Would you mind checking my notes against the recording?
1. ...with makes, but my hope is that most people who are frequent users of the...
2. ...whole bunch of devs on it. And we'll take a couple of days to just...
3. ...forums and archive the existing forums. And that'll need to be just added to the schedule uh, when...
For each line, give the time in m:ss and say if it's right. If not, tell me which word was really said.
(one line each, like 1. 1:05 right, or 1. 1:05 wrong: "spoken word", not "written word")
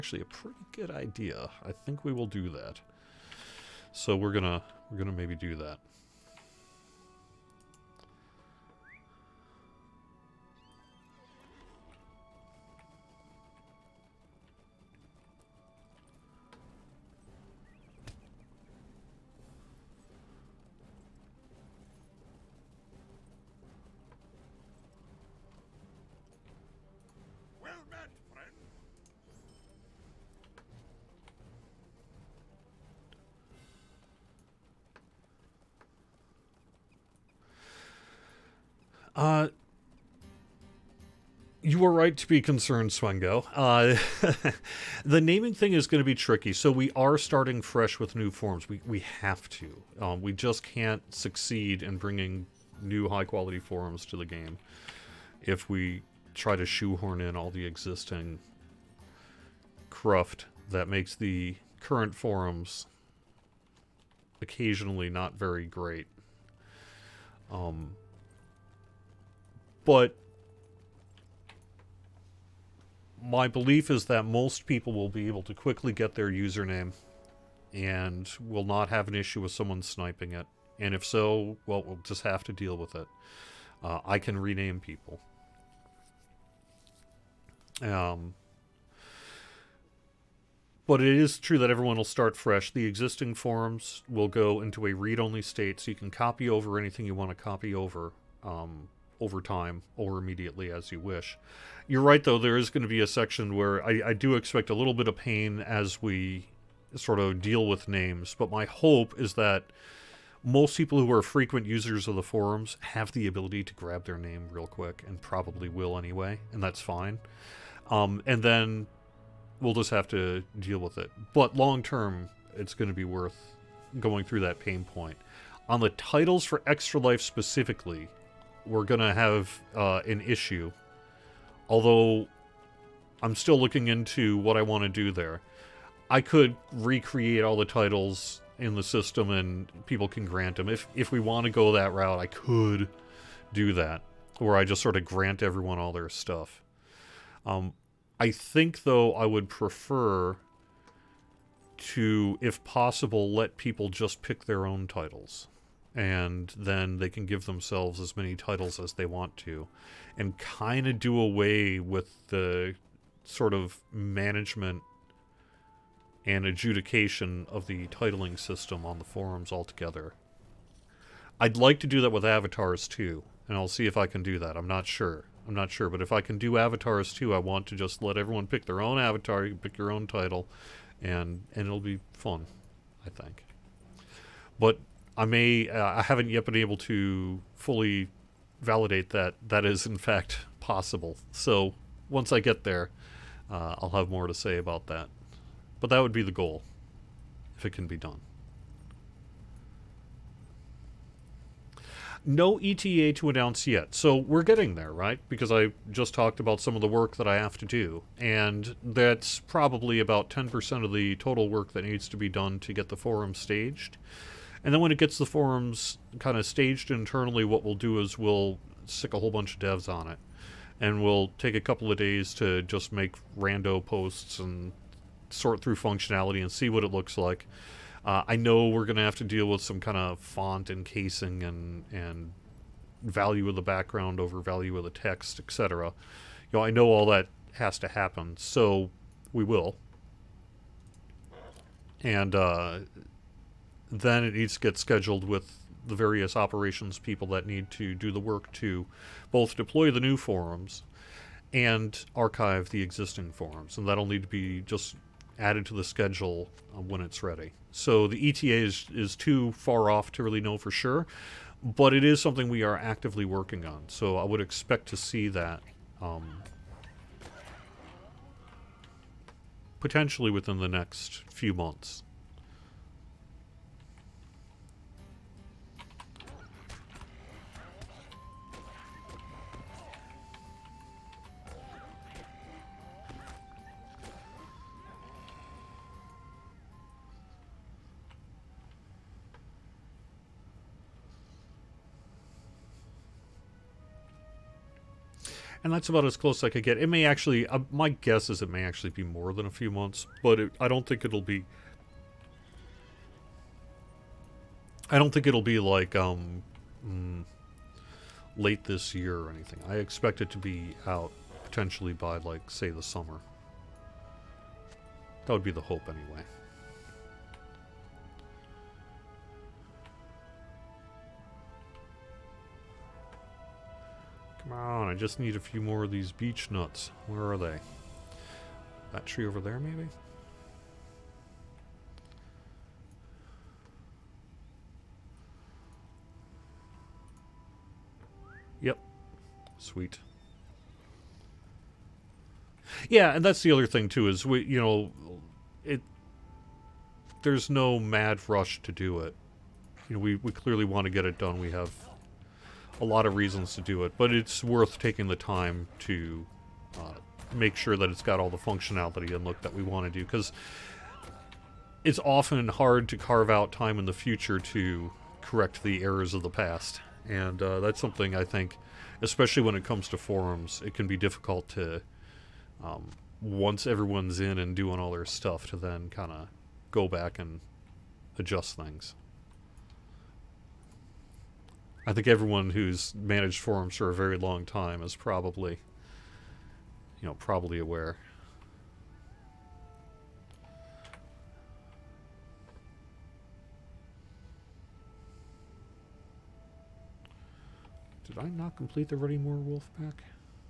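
1. 1:47 wrong: "names", not "makes"
2. 3:39 right
3. 4:10 right.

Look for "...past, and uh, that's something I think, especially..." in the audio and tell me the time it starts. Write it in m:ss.
6:06.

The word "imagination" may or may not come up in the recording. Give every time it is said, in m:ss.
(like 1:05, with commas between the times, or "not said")
not said.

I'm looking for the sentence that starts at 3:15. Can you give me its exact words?
But that would be the goal, if it can be done.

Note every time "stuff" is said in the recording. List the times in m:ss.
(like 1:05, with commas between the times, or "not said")
2:26, 6:15.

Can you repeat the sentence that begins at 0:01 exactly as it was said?
I think we will do that.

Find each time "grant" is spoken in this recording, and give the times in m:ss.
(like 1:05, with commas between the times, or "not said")
2:20, 2:25.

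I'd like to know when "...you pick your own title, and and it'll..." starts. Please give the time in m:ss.
2:59.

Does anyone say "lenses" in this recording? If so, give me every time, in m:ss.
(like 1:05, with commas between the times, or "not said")
not said.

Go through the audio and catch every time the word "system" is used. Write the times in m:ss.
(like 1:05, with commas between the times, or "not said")
2:18, 2:48.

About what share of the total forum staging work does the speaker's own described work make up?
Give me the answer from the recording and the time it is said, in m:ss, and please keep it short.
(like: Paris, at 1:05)
10%, at 3:30.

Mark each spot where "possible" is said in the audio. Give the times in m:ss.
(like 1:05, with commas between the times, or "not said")
2:32, 3:10.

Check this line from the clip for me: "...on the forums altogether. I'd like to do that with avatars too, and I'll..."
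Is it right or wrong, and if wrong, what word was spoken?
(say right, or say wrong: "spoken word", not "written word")
right.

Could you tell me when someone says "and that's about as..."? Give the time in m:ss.
4:55.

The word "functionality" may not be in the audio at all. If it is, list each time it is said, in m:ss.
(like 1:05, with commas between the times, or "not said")
3:45, 5:58.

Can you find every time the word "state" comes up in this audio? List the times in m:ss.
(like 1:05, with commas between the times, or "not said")
1:35.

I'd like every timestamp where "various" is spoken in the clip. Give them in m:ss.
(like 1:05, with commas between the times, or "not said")
4:05.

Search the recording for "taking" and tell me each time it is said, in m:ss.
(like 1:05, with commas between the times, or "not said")
5:54.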